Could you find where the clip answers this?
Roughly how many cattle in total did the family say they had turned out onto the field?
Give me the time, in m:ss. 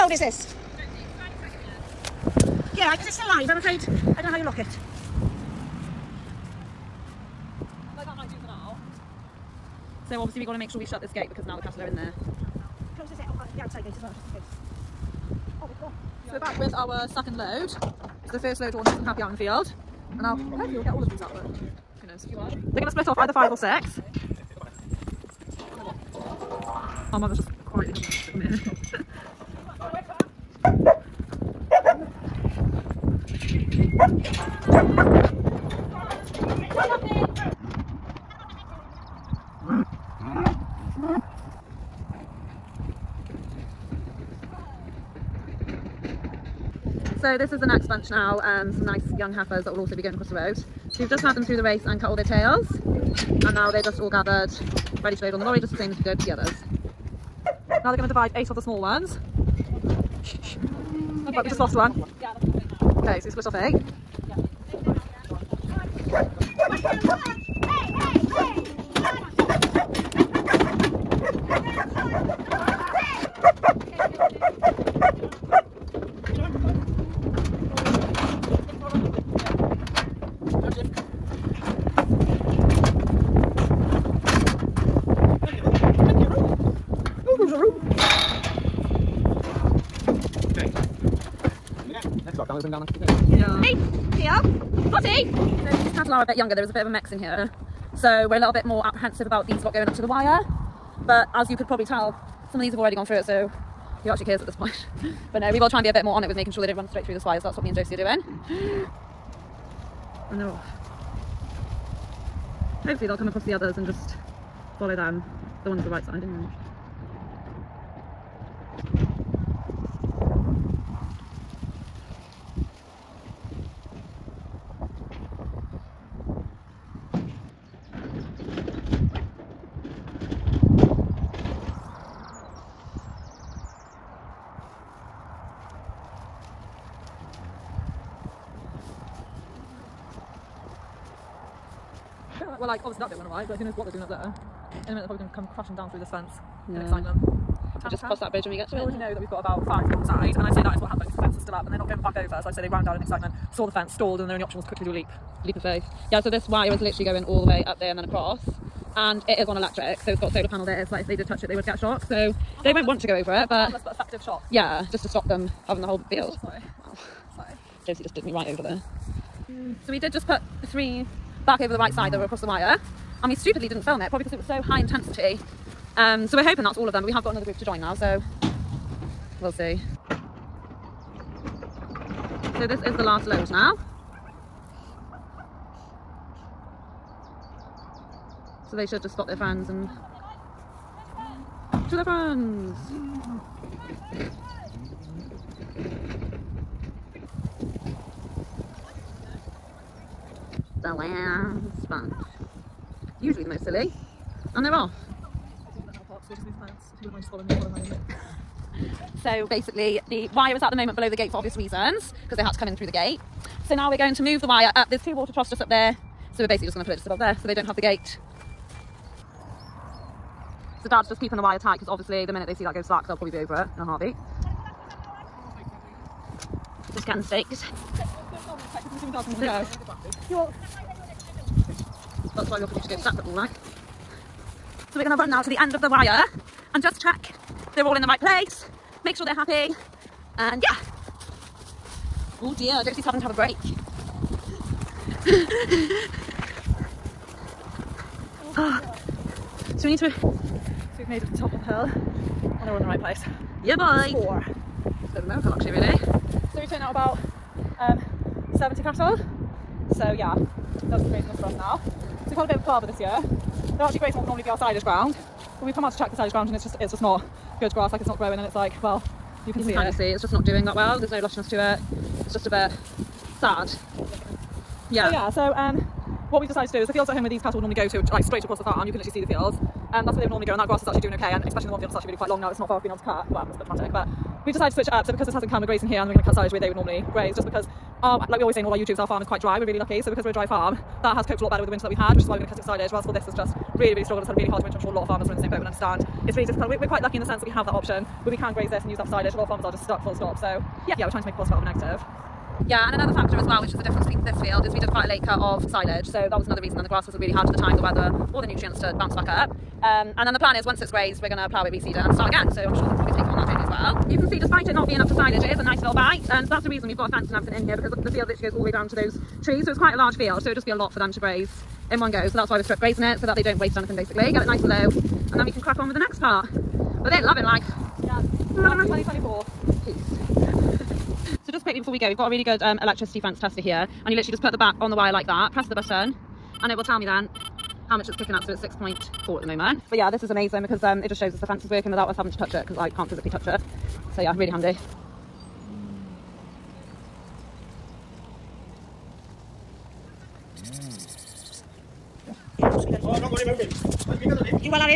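4:18.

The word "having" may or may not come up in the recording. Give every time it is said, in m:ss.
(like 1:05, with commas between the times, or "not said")
0:27, 2:45, 4:03, 5:42.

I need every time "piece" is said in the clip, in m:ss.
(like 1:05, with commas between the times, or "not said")
not said.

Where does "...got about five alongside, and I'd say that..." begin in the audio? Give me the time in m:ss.
2:29.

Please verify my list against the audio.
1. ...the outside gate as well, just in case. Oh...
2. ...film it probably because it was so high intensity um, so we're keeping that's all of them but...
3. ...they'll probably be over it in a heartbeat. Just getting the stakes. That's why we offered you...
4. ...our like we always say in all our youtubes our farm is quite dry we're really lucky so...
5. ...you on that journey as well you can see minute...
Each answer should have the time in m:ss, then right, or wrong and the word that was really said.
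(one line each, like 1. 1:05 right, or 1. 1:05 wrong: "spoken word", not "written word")
1. 0:13 right
2. 2:53 wrong: "hoping", not "keeping"
3. 3:43 right
4. 4:48 right
5. 5:13 wrong: "despite", not "minute".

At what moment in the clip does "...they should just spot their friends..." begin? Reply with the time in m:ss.
3:08.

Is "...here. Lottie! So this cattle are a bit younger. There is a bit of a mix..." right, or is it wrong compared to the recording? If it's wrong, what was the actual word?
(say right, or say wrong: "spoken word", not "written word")
right.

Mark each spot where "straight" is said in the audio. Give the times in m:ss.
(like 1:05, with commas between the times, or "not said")
1:46, 4:38.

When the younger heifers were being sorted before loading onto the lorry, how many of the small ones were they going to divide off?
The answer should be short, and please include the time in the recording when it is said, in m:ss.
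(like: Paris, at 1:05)
8, at 0:58.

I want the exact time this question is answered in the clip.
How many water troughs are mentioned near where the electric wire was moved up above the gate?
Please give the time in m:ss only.
3:35.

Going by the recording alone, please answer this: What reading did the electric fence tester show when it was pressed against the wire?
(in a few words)
6.4.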